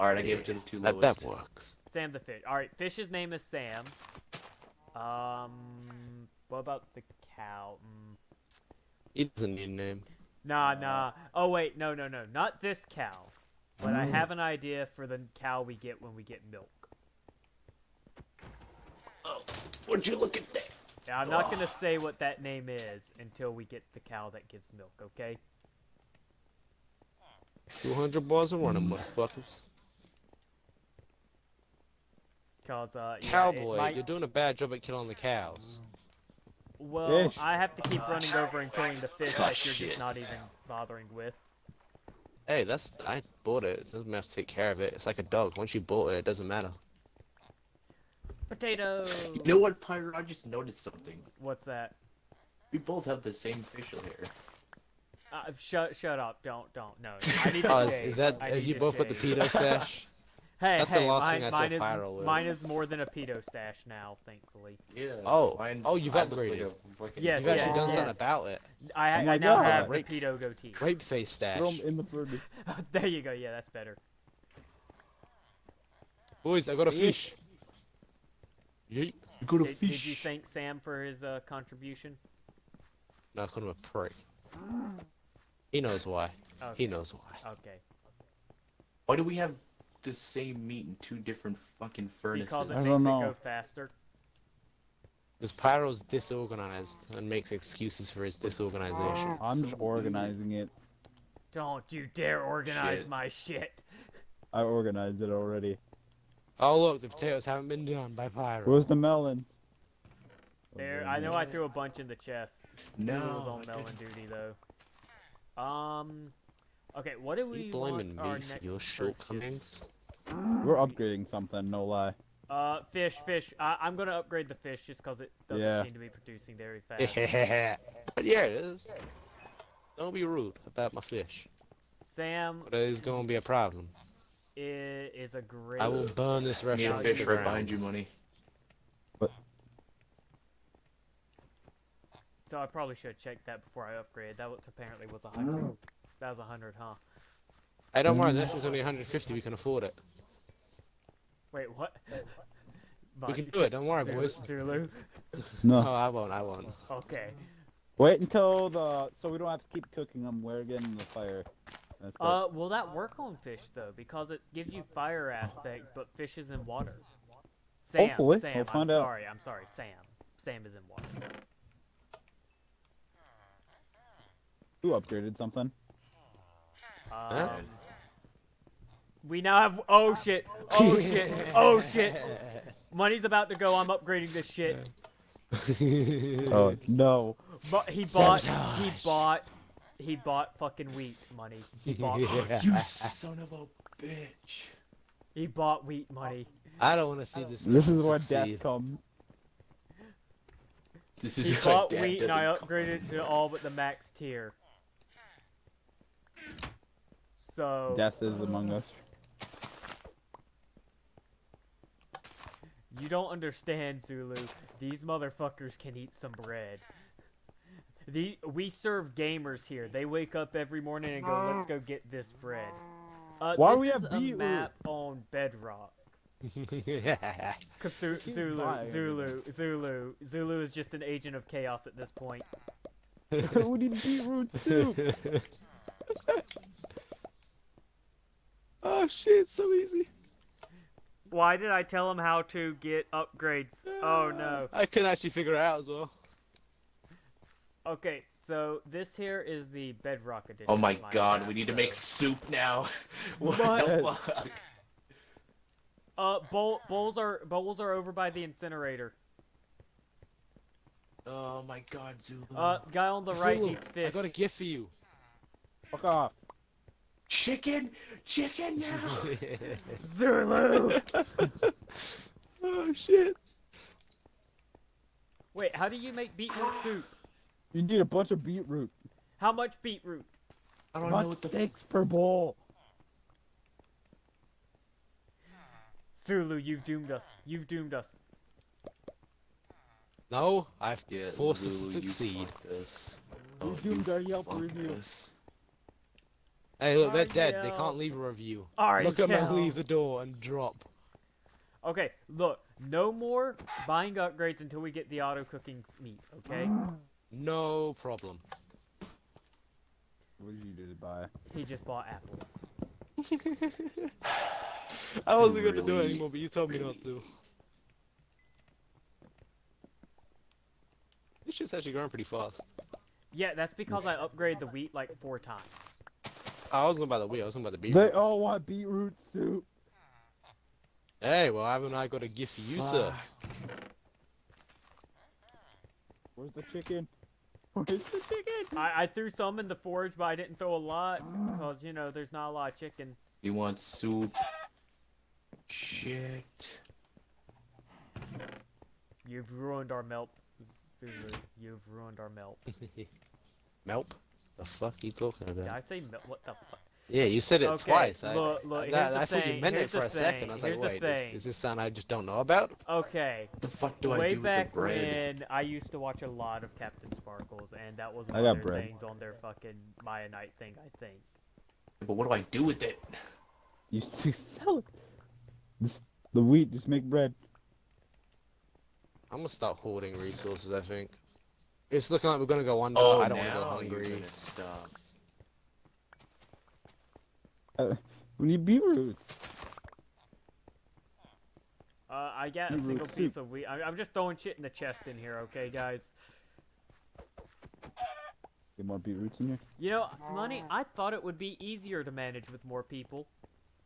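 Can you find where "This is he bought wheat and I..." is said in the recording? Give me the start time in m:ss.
3:21.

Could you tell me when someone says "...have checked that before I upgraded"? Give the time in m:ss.
2:23.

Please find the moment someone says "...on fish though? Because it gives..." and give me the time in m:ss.
2:43.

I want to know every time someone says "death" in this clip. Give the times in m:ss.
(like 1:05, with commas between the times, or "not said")
3:18, 3:27.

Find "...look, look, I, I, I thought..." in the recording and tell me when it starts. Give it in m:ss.
5:58.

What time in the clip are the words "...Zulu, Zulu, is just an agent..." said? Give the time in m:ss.
3:49.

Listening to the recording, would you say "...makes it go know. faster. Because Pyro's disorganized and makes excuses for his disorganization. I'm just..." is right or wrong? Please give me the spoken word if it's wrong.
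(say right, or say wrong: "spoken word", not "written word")
right.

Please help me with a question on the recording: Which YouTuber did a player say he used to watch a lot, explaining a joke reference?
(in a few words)
CaptainSparklez.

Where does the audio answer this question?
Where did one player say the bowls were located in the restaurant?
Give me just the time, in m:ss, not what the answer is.
4:17.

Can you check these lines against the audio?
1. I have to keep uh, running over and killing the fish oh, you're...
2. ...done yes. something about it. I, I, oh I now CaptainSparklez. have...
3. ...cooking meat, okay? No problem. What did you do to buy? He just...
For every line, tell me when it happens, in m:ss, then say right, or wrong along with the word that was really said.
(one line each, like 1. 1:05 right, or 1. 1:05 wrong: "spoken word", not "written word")
1. 0:37 right
2. 1:07 wrong: "God", not "CaptainSparklez"
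3. 5:05 right.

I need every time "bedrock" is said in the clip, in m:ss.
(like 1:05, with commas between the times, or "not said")
3:45, 4:10.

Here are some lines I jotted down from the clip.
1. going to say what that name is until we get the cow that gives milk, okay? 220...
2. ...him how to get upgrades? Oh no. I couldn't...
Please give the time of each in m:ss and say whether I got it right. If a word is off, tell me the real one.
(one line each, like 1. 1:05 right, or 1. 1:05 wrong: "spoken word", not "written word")
1. 0:21 wrong: "200", not "220"
2. 4:02 right.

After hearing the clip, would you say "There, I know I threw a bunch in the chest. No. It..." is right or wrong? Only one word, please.
right.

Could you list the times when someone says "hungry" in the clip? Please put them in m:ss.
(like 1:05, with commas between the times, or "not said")
6:23.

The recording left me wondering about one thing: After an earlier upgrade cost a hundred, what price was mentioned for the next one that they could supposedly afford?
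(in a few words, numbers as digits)
150.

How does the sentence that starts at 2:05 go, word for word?
seem to be producing very fast.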